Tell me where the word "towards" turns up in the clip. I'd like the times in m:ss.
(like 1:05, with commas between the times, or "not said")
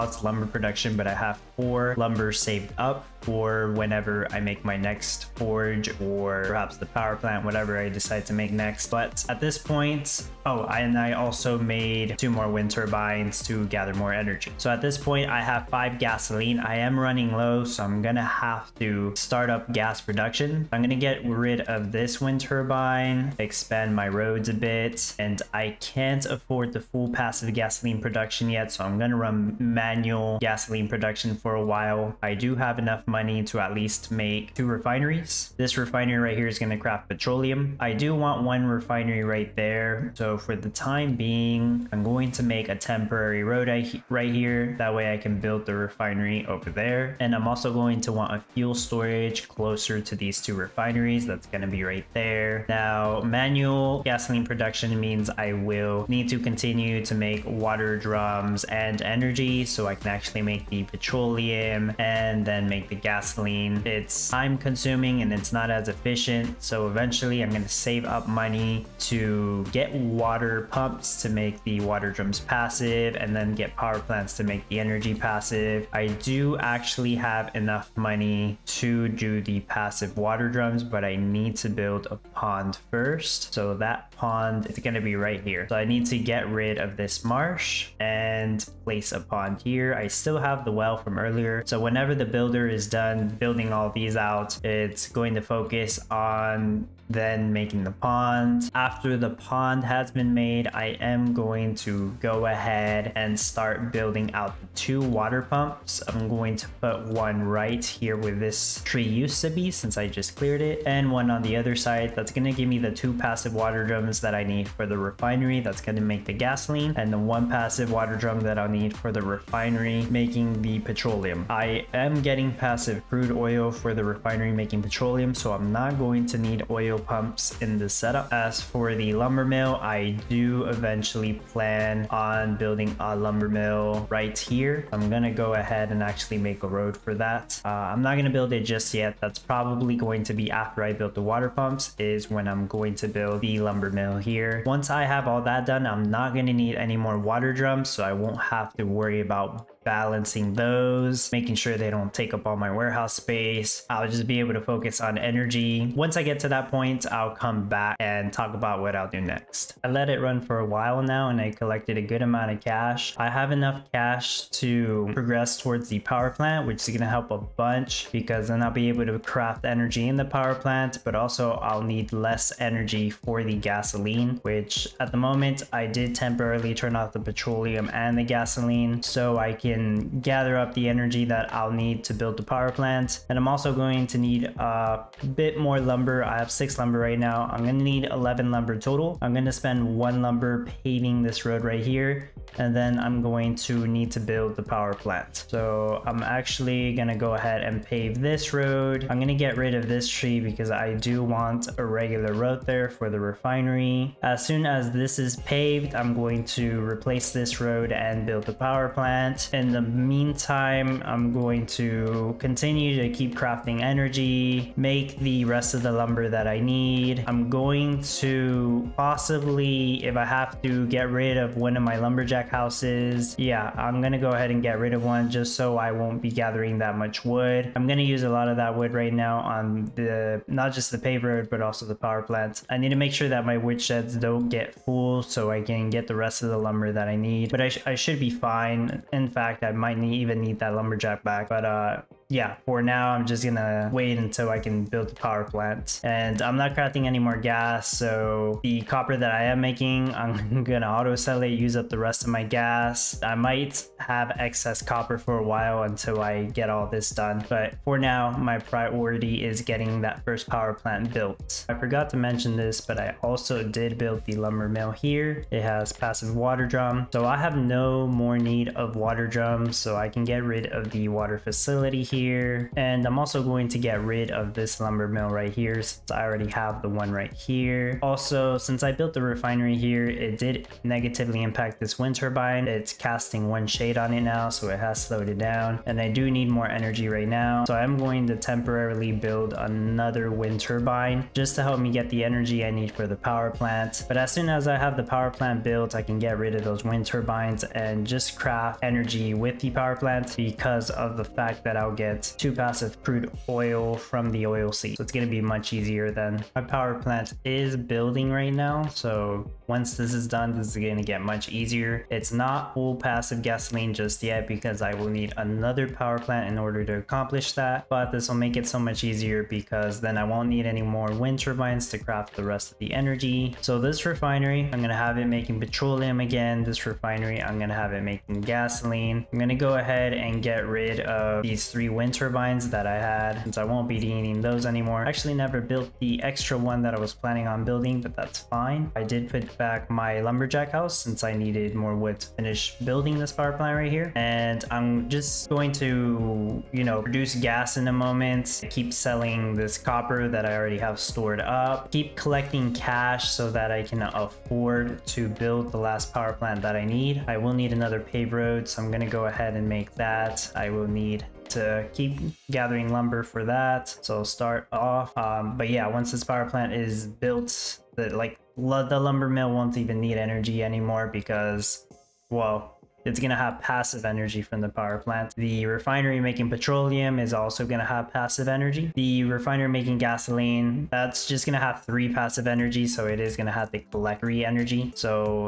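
2:45.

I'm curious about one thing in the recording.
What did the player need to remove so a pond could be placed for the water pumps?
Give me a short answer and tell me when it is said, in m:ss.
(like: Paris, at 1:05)
marsh, at 1:27.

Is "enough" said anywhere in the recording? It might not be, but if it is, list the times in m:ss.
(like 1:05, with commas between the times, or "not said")
0:32, 1:17, 2:43.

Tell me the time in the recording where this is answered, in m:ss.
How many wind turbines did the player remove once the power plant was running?
5:31.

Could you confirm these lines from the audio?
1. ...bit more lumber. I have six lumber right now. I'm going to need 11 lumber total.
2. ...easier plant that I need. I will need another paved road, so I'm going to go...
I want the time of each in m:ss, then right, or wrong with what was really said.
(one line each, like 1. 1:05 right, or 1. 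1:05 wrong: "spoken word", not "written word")
1. 3:05 right
2. 5:56 wrong: "power", not "easier".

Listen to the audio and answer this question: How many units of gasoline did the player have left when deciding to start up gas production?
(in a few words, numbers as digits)
5.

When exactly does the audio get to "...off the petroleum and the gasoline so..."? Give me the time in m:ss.
2:56.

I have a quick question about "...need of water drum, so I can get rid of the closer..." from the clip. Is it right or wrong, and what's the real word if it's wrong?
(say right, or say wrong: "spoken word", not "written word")
wrong: "water", not "closer".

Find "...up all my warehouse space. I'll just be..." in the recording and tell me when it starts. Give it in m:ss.
2:32.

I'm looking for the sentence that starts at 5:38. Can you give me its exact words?
I did put back my lumberjack house since I needed more wood to finish building this power plant right here.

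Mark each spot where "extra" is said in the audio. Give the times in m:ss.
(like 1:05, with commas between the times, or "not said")
5:36.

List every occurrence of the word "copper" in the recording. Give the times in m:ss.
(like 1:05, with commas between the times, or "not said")
4:08, 4:14, 5:49.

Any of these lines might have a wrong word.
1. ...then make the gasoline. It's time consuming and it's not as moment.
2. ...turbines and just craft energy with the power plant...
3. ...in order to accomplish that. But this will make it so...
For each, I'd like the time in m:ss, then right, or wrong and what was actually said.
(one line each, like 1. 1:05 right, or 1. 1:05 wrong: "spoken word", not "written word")
1. 1:02 wrong: "efficient", not "moment"
2. 4:57 right
3. 5:16 right.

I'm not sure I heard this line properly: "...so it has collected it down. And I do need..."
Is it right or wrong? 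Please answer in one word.
wrong.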